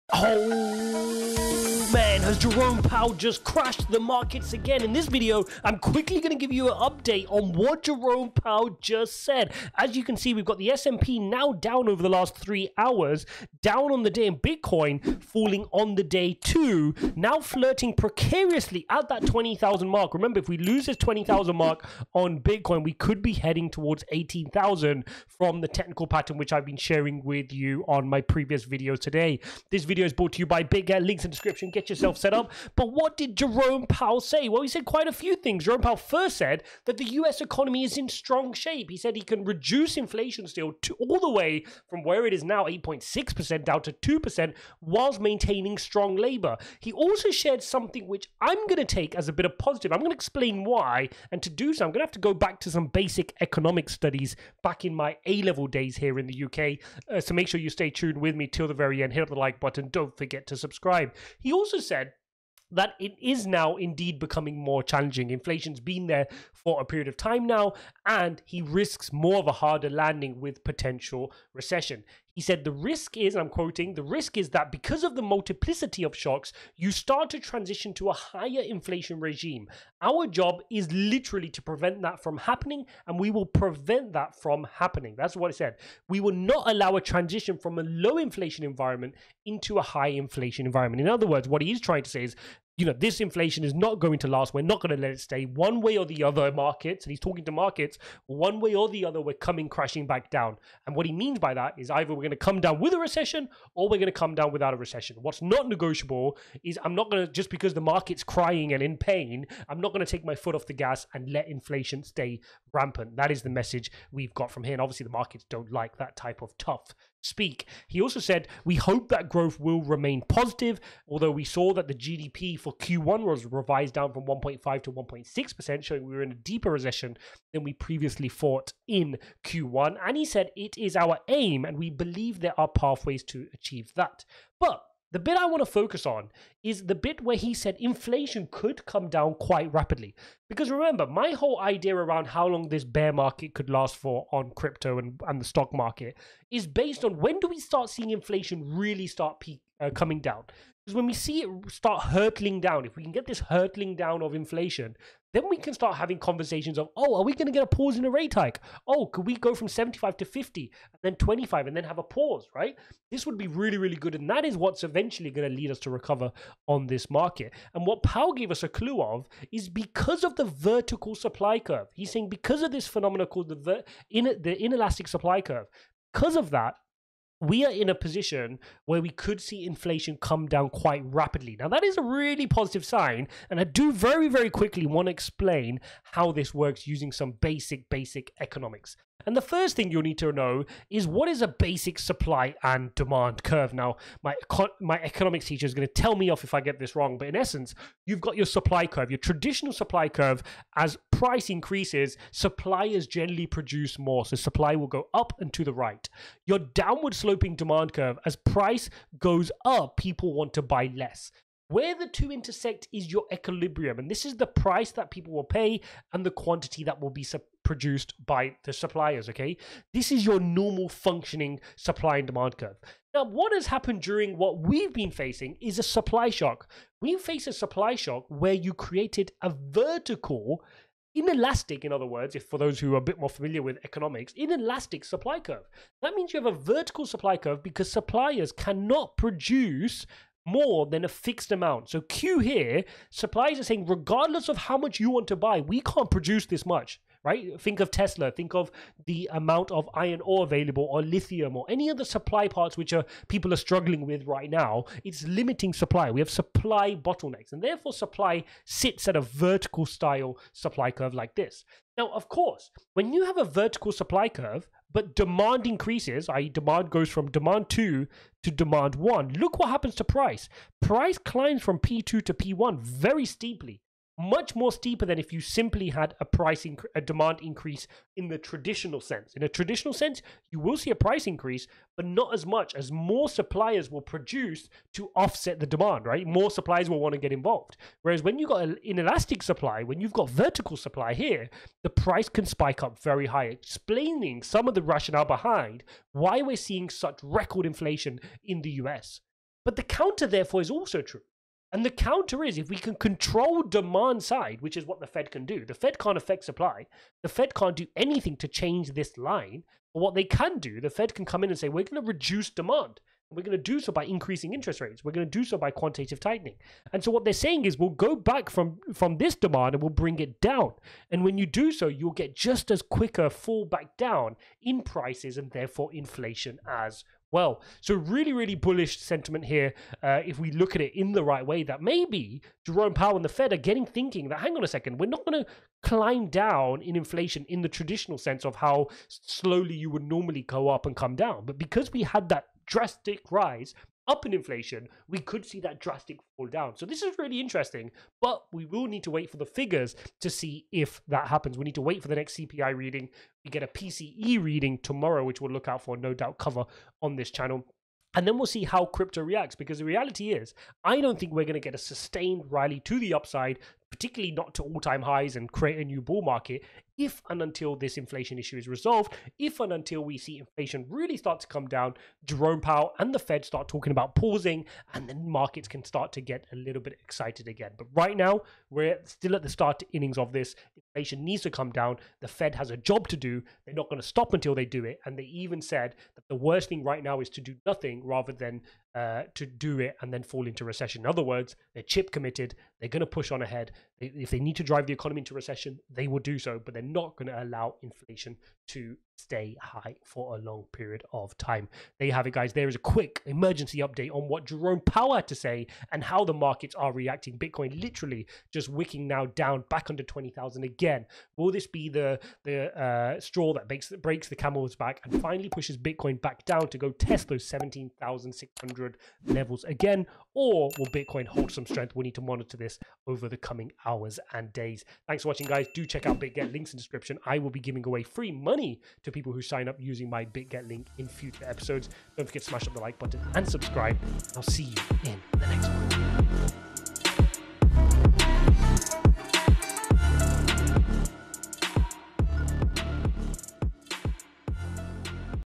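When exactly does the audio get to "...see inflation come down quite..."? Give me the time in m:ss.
2:59.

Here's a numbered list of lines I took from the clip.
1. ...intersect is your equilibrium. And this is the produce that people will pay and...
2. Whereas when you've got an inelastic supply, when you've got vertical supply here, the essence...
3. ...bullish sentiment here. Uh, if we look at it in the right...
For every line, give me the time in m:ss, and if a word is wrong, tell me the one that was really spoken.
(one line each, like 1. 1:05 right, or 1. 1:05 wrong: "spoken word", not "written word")
1. 3:32 wrong: "price", not "produce"
2. 4:48 wrong: "price", not "essence"
3. 5:28 right.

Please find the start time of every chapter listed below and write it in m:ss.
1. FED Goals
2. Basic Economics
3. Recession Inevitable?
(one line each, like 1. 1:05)
1. 1:10
2. 3:10
3. 6:00.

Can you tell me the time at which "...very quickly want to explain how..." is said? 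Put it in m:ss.
3:04.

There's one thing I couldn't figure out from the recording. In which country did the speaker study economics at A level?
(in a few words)
UK.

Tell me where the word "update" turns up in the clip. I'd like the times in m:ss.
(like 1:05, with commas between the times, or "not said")
0:06, 6:43.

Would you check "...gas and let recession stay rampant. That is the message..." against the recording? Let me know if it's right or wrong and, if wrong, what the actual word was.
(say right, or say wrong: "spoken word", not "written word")
wrong: "inflation", not "recession".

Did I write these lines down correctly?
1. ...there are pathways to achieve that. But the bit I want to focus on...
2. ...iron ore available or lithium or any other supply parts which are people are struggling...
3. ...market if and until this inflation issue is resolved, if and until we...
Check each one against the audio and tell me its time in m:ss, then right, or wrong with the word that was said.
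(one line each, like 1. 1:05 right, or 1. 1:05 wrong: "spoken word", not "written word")
1. 2:12 right
2. 4:09 right
3. 6:06 right.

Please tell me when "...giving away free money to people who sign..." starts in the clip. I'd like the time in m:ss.
7:07.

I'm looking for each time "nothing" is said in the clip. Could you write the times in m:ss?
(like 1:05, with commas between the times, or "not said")
6:27.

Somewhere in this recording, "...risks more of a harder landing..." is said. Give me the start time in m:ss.
1:08.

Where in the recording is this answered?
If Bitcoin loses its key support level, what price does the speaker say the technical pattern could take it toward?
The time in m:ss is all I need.
0:24.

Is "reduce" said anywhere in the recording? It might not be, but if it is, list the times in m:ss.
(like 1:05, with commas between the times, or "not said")
0:39, 5:12.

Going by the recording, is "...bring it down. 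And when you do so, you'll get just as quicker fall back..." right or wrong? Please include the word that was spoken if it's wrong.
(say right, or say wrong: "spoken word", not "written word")
right.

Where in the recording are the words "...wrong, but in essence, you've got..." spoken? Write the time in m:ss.
3:16.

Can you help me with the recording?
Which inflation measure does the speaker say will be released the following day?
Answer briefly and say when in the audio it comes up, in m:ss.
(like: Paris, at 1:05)
PCE, at 5:53.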